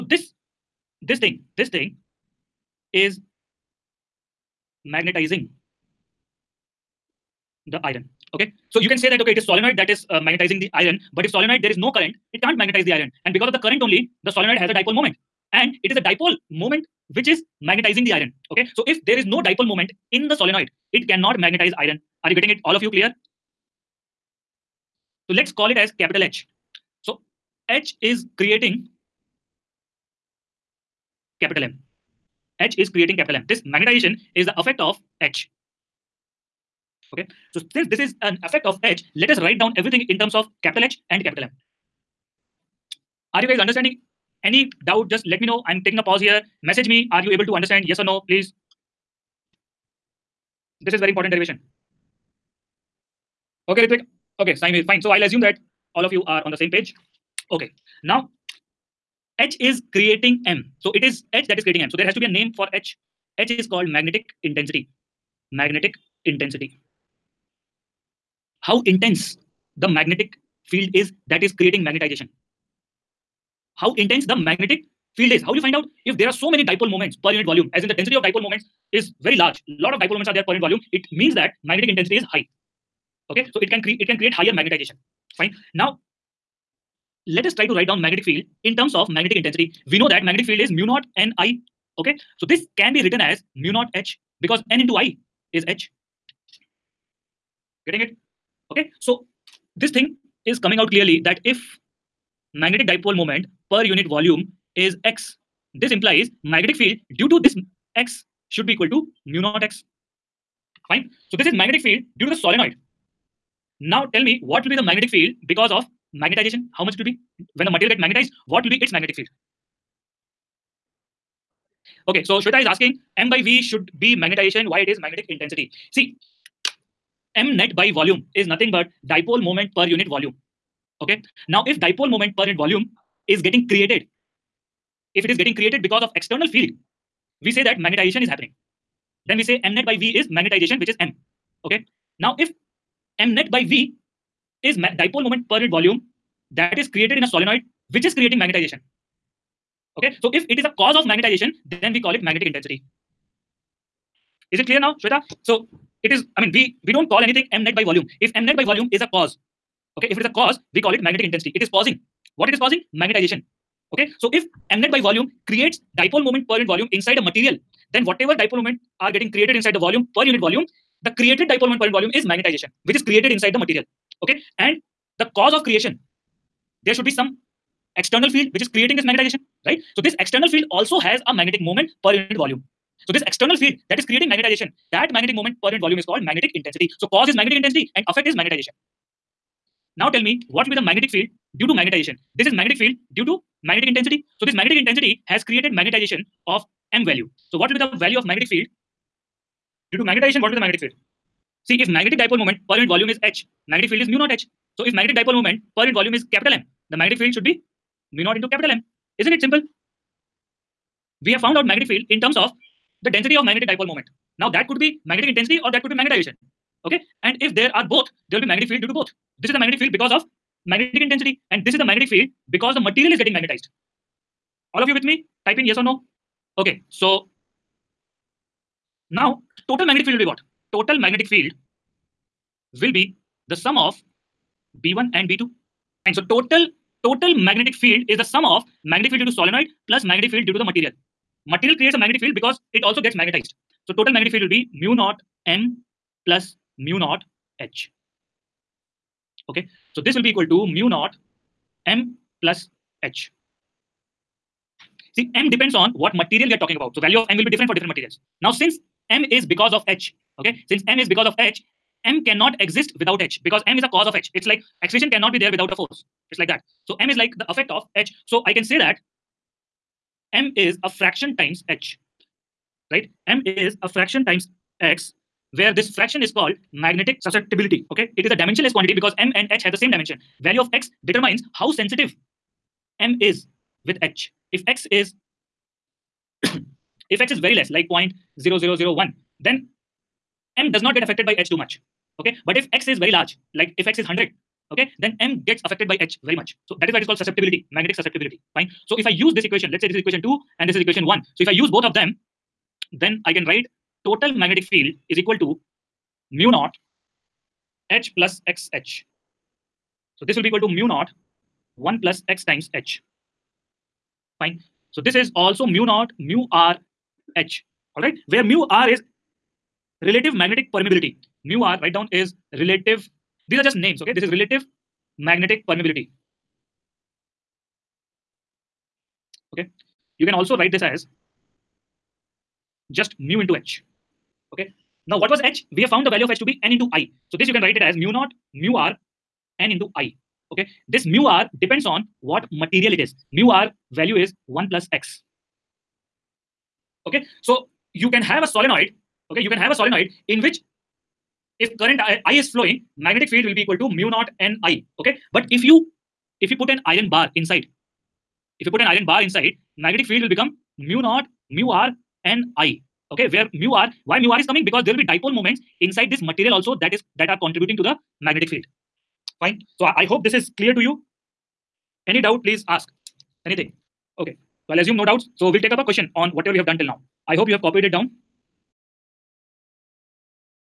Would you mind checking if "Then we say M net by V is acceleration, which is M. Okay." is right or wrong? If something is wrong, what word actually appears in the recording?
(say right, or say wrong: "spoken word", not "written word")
wrong: "magnetization", not "acceleration".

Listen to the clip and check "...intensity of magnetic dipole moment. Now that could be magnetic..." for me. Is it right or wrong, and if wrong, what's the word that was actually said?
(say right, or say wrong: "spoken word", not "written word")
wrong: "density", not "intensity".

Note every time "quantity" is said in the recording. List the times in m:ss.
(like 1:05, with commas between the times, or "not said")
4:38.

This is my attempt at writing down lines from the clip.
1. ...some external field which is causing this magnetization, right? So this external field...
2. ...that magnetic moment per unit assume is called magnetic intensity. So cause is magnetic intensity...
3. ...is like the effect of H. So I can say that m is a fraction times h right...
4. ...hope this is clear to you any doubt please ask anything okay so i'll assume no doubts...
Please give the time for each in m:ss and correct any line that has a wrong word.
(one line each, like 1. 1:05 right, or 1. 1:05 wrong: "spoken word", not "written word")
1. 2:57 wrong: "creating", not "causing"
2. 3:04 wrong: "volume", not "assume"
3. 4:27 right
4. 6:10 right.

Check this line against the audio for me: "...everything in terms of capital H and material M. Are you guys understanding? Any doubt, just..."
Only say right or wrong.
wrong.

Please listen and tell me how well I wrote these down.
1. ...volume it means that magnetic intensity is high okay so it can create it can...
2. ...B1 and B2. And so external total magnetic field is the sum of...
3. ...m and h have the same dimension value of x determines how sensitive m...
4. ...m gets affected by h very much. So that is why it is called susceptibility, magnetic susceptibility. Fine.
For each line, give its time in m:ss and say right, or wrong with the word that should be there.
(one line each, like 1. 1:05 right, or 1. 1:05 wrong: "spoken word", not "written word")
1. 1:20 right
2. 3:54 wrong: "total", not "external"
3. 4:39 right
4. 4:55 right.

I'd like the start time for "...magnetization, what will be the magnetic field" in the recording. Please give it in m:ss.
3:20.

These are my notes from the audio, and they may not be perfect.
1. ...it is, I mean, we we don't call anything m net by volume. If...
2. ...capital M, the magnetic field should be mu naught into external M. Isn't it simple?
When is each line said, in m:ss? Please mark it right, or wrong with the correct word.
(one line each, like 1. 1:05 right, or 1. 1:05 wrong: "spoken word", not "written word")
1. 2:36 right
2. 3:26 wrong: "capital", not "external".